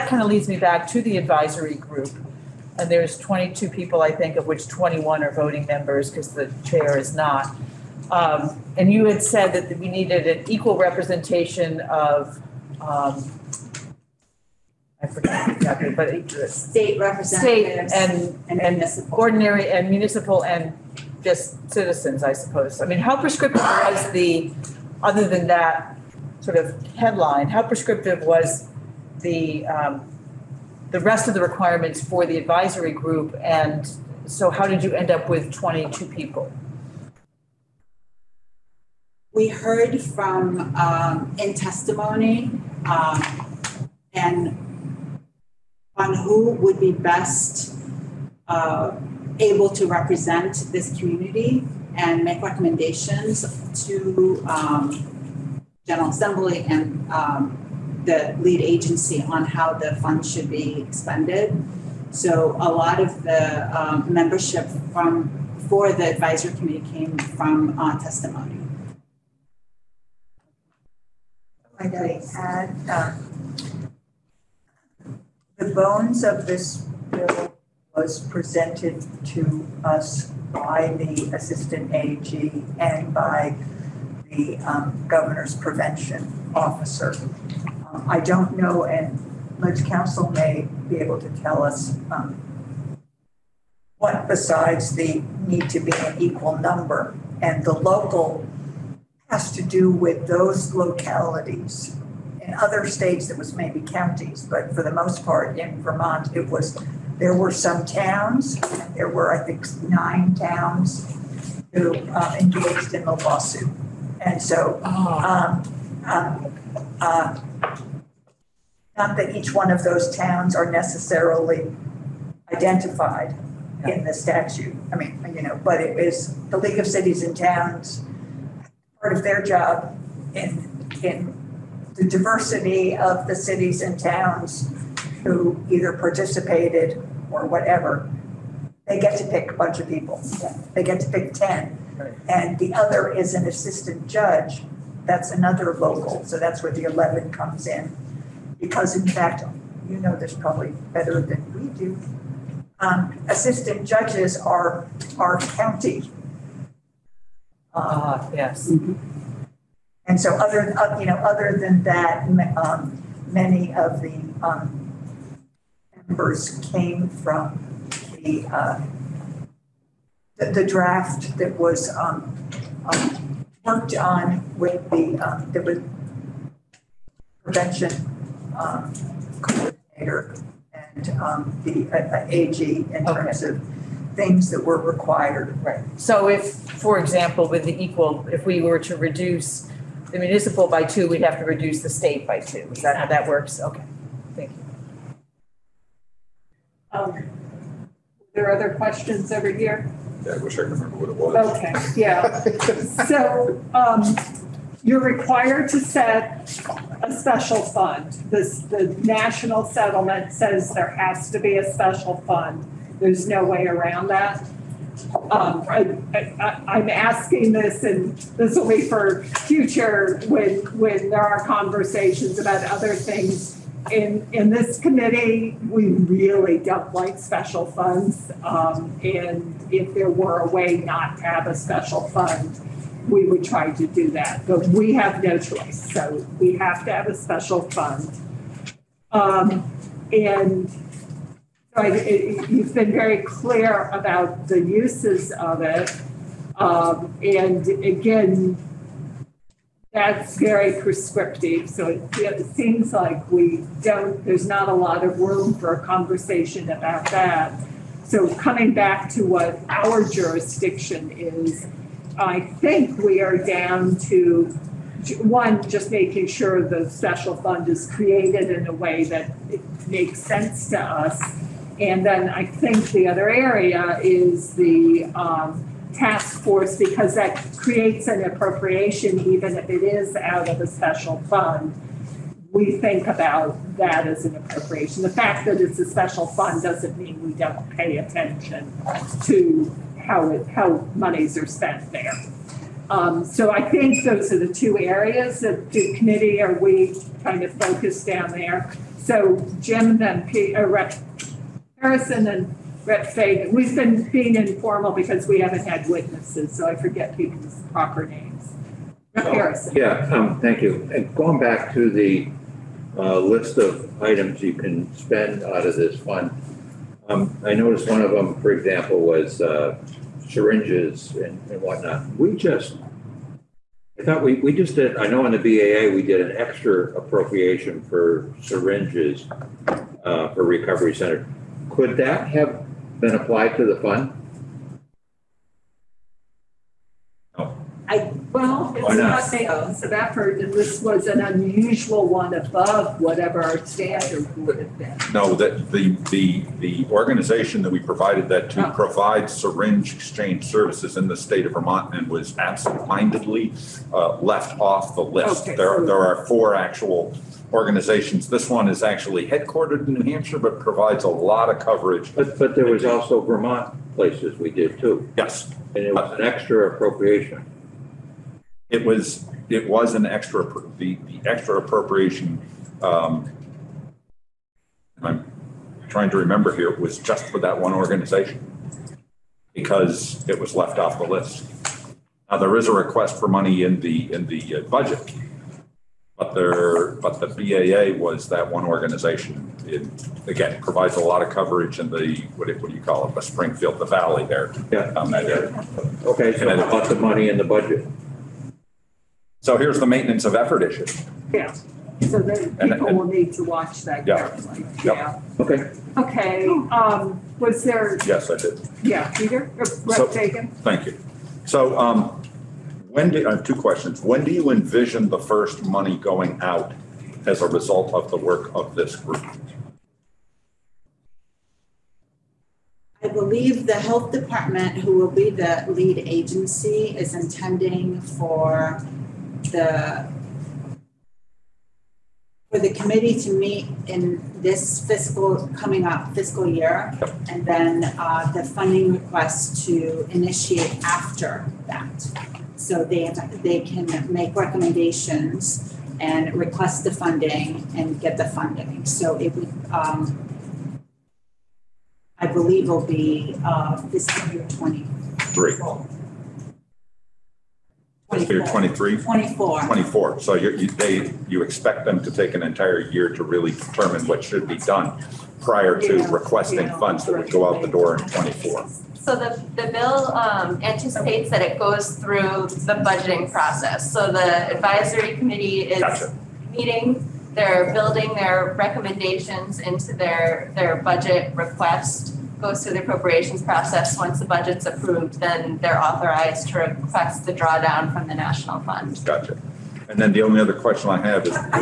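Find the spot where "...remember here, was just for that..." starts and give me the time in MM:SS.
06:16.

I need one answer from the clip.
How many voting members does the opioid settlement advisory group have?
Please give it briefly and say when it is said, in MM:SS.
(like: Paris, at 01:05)
21, at 00:04.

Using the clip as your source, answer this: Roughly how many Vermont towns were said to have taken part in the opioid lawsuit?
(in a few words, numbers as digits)
9.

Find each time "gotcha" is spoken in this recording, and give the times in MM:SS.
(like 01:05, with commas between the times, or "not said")
07:55, 08:09.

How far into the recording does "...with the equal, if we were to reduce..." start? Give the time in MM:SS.
03:07.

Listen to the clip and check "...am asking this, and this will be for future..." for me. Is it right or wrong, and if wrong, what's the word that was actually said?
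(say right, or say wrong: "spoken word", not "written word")
right.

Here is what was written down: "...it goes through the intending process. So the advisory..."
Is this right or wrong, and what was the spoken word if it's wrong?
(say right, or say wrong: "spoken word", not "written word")
wrong: "budgeting", not "intending".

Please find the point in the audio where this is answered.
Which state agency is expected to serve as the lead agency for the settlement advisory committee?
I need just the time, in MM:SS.
07:03.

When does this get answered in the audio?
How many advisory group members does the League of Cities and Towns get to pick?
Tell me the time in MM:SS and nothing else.
02:21.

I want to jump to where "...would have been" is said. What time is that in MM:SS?
05:44.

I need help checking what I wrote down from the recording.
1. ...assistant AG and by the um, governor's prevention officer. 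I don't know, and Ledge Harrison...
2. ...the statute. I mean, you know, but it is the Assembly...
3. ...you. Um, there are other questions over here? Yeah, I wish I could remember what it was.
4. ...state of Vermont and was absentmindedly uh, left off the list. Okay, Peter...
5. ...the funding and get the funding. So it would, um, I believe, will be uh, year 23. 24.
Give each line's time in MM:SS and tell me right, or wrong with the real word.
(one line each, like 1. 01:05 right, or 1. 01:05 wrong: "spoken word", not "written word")
1. 01:21 wrong: "Council", not "Harrison"
2. 02:04 wrong: "League", not "Assembly"
3. 03:14 right
4. 05:51 wrong: "There", not "Peter"
5. 07:26 right.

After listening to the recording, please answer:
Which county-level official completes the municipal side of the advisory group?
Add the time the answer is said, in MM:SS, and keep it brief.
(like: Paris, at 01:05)
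Assistant judge, at 02:23.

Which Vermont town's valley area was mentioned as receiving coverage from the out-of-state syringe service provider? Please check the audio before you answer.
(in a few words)
Springfield.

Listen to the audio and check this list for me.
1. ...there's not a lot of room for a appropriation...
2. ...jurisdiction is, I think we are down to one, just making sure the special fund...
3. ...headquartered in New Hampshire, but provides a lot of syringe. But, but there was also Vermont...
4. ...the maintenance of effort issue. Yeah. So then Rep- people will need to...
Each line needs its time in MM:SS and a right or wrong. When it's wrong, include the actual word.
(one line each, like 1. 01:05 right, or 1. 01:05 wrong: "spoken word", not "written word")
1. 04:14 wrong: "conversation", not "appropriation"
2. 04:20 right
3. 05:59 wrong: "coverage", not "syringe"
4. 06:39 wrong: "And", not "Rep".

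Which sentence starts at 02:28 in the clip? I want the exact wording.
Because in fact, you know this probably better than we do.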